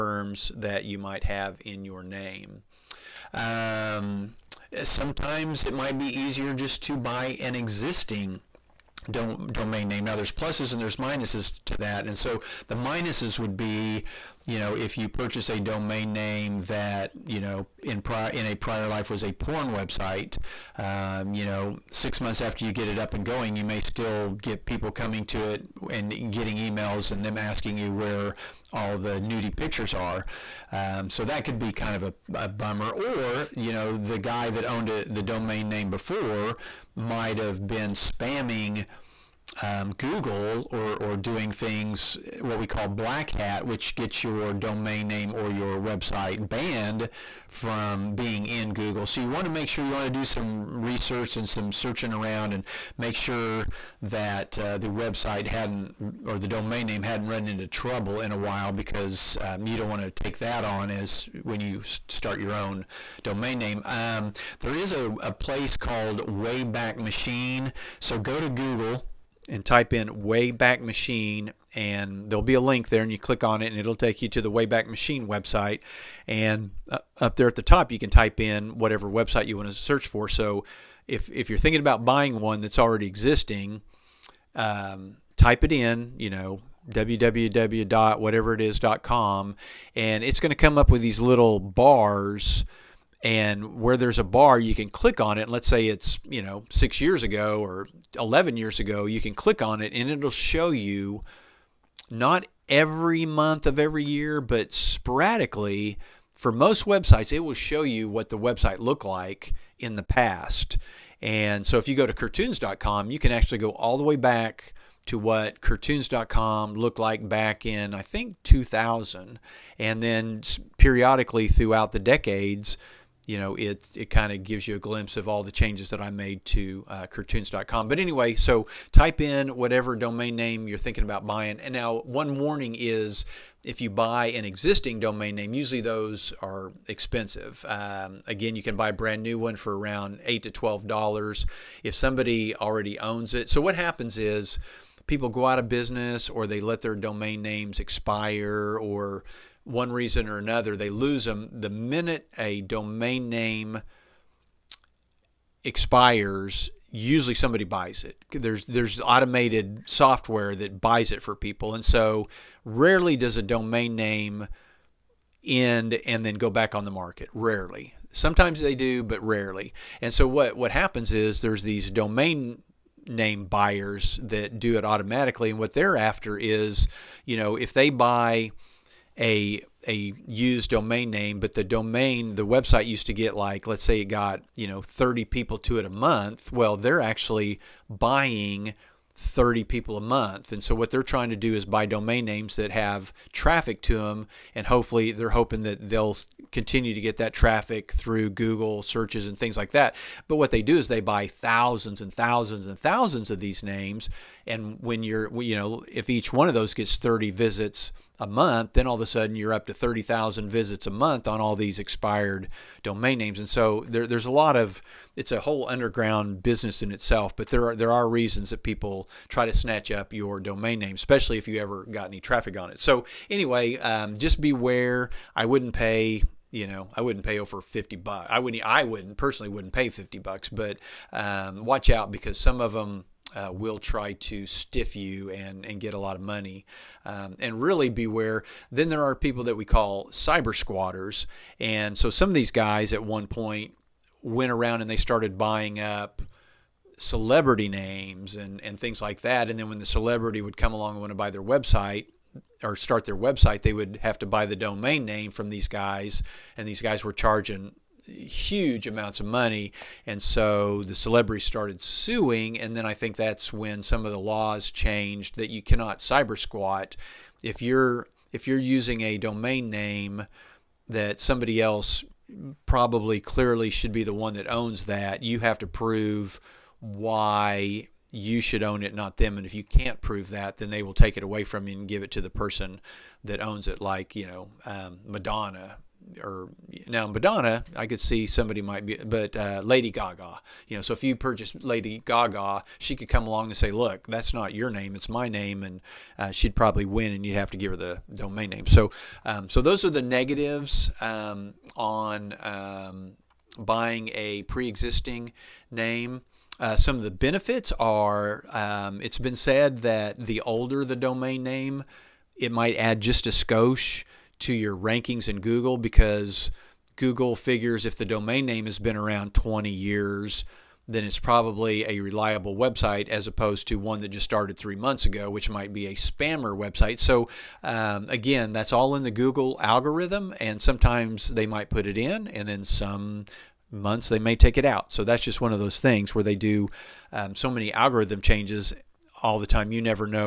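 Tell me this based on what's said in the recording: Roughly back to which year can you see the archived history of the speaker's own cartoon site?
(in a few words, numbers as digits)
2000.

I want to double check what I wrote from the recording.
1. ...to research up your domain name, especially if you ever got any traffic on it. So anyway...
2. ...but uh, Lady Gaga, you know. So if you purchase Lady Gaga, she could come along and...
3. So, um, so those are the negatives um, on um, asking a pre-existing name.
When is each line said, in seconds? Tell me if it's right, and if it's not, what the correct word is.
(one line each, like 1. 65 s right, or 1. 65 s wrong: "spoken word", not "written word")
1. 219 s wrong: "snatch", not "research"
2. 288 s right
3. 298 s wrong: "buying", not "asking".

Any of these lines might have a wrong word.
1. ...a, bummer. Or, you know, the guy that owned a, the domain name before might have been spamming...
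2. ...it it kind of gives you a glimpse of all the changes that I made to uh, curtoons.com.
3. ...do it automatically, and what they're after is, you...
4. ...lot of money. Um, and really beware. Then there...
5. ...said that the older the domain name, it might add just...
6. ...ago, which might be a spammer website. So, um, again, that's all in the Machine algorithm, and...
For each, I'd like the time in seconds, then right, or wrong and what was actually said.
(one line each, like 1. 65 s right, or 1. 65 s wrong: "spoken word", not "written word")
1. 32 s right
2. 123 s right
3. 174 s right
4. 235 s right
5. 309 s right
6. 325 s wrong: "Google", not "Machine".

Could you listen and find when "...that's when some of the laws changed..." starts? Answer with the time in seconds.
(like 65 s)
263 s.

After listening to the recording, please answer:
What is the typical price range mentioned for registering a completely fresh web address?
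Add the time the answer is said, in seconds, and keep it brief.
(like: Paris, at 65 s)
$8 to $12, at 140 s.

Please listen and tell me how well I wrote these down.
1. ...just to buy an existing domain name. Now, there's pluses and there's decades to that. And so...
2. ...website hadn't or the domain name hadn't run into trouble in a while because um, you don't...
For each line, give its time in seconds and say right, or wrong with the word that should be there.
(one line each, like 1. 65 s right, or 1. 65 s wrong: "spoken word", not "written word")
1. 6 s wrong: "minuses", not "decades"
2. 54 s right.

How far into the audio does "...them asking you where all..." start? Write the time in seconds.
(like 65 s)
27 s.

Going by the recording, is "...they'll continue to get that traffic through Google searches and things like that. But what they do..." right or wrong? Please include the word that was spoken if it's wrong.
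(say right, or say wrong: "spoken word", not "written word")
right.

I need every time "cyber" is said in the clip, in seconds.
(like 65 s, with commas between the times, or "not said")
240 s, 265 s.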